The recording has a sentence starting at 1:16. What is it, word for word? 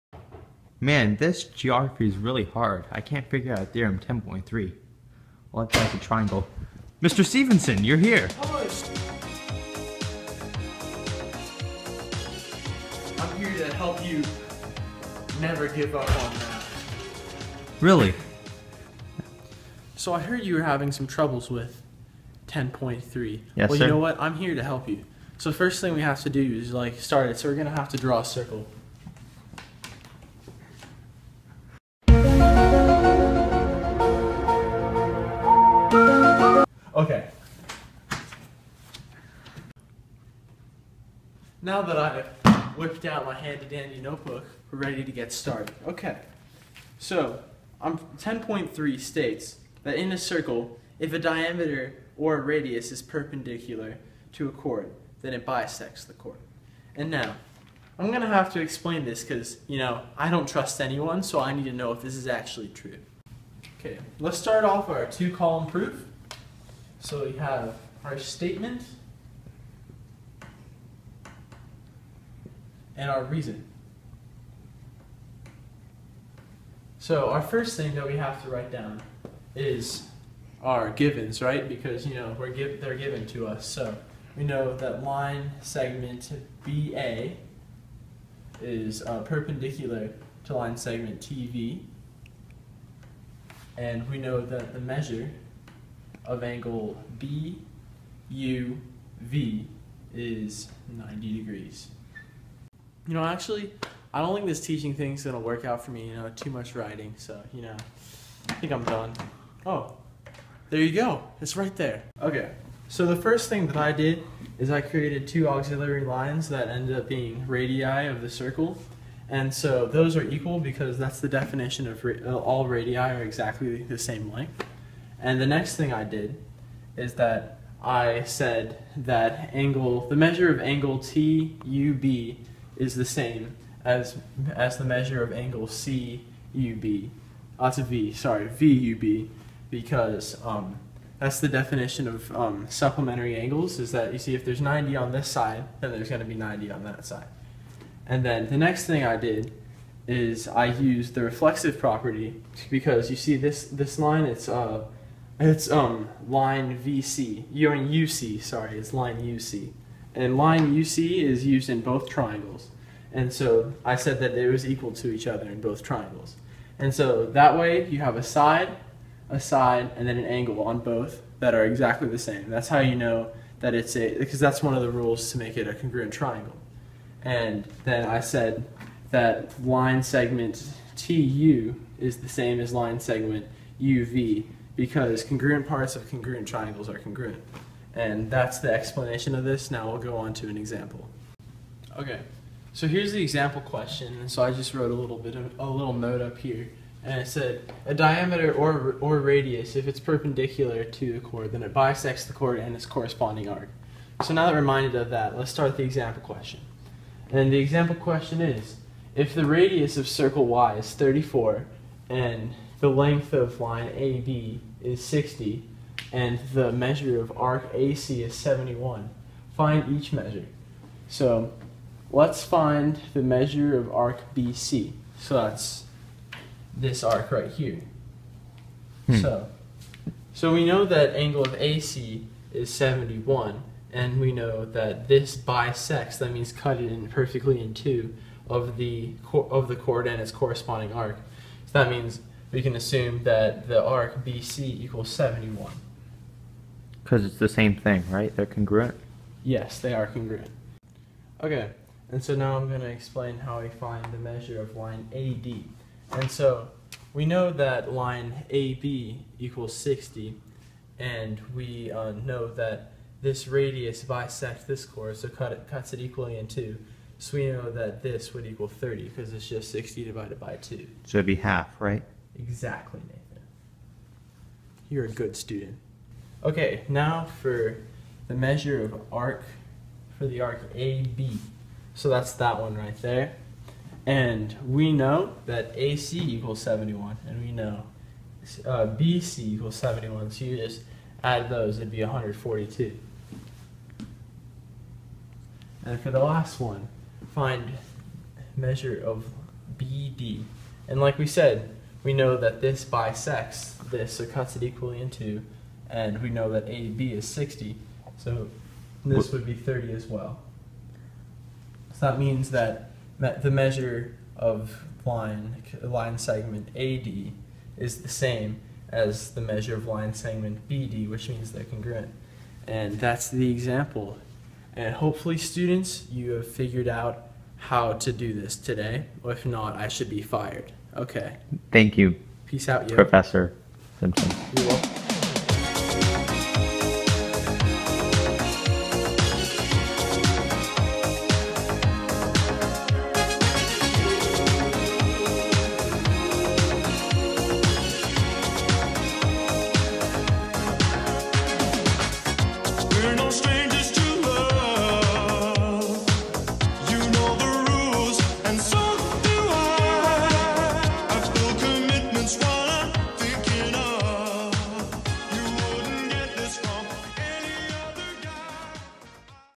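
So our first thing that we have to write down is our givens, right?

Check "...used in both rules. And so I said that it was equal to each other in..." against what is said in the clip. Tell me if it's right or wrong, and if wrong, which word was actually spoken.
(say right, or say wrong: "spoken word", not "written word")
wrong: "triangles", not "rules".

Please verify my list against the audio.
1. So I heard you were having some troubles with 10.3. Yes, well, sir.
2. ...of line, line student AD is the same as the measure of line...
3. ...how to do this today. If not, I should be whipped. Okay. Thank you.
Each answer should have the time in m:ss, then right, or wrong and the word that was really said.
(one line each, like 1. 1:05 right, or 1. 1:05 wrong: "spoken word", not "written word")
1. 0:19 right
2. 5:14 wrong: "segment", not "student"
3. 5:27 wrong: "fired", not "whipped".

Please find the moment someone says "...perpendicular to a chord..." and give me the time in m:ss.
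0:53.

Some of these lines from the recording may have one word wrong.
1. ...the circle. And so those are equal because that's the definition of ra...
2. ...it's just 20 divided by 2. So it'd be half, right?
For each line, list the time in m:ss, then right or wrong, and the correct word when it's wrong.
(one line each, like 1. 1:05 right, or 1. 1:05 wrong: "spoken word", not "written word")
1. 1:58 right
2. 4:29 wrong: "60", not "20".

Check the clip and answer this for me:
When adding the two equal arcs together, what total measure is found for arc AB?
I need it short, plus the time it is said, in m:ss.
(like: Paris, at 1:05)
142, at 4:52.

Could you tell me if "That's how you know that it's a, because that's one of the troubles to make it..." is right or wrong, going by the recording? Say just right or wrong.
wrong.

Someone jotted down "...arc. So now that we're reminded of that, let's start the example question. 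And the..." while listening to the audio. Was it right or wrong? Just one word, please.
right.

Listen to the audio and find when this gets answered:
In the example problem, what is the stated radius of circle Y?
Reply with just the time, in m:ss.
3:30.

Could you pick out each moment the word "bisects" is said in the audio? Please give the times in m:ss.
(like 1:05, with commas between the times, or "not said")
0:55, 3:21, 3:55, 4:24, 5:02.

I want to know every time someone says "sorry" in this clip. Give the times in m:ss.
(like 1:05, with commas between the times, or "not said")
2:18, 2:38.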